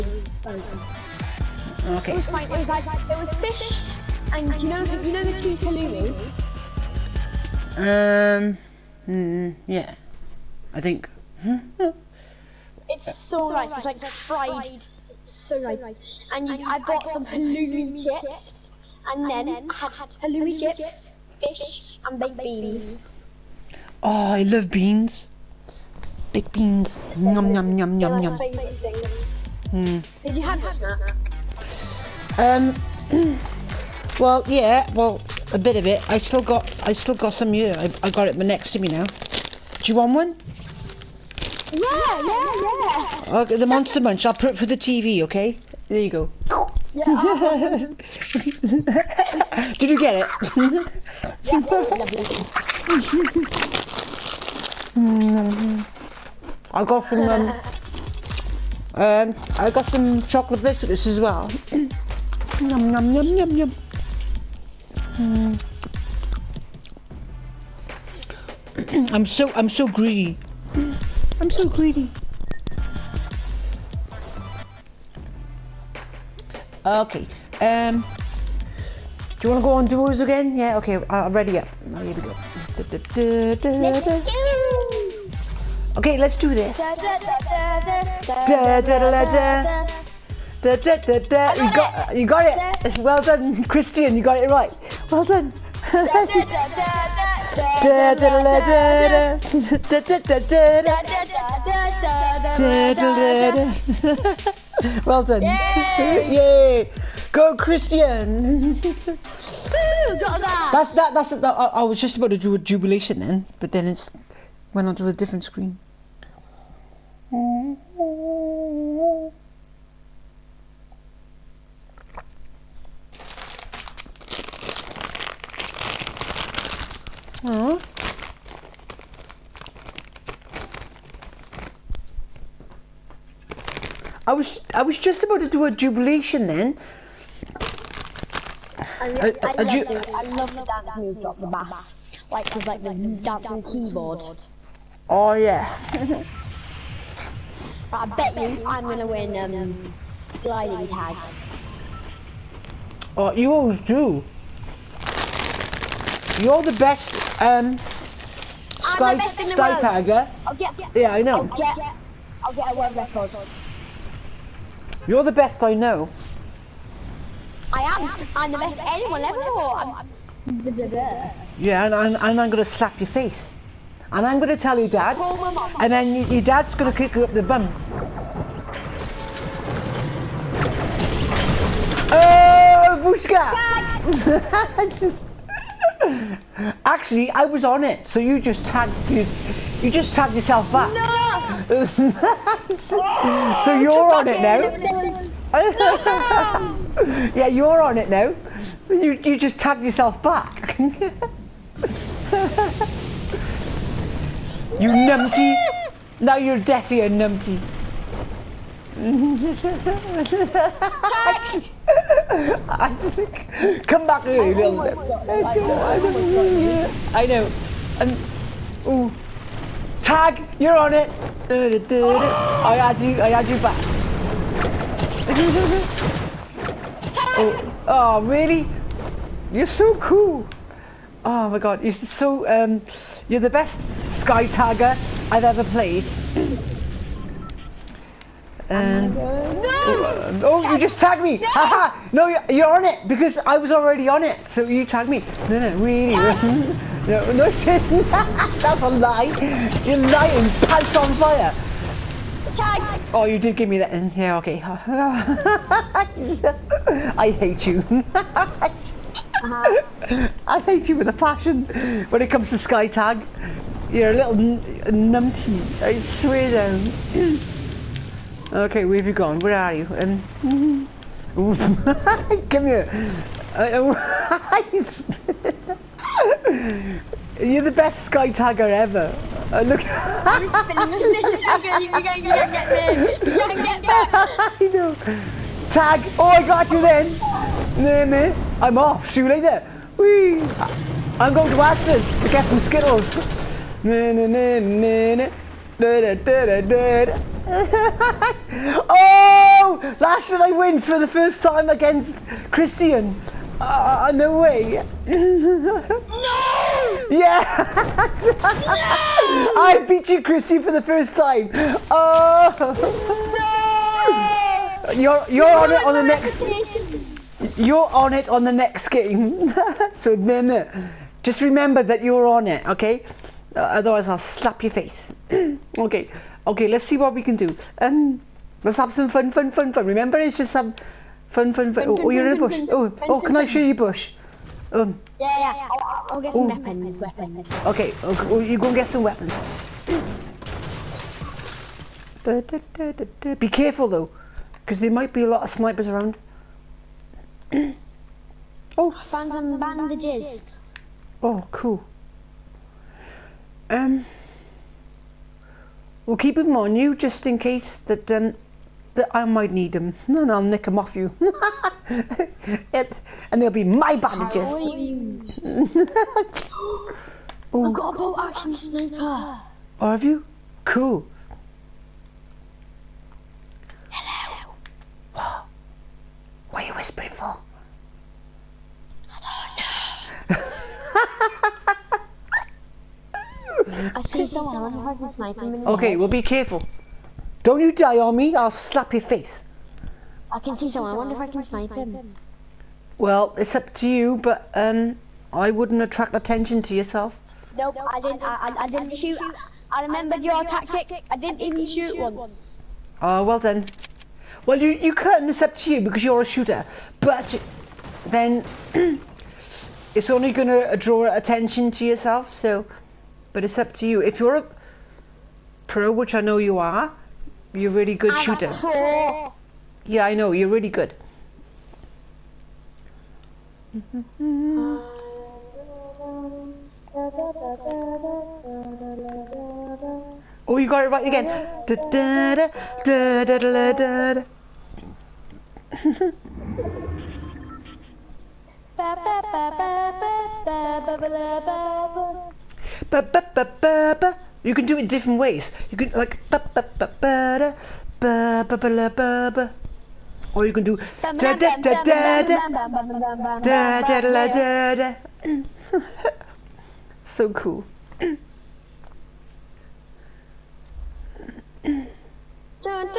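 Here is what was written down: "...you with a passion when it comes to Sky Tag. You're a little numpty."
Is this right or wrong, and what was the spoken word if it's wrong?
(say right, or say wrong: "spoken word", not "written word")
right.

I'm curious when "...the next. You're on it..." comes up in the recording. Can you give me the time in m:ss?
5:15.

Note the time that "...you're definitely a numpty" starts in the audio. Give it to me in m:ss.
3:26.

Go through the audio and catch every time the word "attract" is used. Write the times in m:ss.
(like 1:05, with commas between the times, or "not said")
6:35.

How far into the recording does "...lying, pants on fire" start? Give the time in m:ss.
4:09.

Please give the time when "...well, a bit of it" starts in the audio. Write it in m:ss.
0:34.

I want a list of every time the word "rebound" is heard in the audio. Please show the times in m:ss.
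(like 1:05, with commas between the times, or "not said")
not said.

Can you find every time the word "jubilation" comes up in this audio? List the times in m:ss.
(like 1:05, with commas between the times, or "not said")
1:52, 2:15.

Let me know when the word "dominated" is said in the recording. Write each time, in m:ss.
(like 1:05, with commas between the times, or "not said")
not said.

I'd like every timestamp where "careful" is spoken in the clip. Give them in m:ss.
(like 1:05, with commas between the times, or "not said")
5:43, 6:26.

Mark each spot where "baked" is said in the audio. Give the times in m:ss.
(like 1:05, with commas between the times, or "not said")
0:22, 0:26.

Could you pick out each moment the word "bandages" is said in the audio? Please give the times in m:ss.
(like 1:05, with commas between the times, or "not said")
5:49, 6:03.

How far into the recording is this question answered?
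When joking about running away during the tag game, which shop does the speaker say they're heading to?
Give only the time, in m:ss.
4:51.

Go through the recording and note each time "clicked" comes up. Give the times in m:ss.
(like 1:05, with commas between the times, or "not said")
not said.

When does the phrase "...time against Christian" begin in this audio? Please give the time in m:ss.
5:01.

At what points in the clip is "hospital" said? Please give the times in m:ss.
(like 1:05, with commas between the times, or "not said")
not said.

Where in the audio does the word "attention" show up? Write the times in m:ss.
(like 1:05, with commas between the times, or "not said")
6:36, 6:51.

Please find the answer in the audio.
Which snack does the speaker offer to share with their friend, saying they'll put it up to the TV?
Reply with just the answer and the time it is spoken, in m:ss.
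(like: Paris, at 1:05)
Monster Munch, at 0:43.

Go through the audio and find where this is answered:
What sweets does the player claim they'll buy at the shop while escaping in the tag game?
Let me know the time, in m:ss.
4:52.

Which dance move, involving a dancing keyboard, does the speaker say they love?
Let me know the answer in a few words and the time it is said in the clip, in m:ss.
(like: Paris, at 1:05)
Drop the bass, at 2:21.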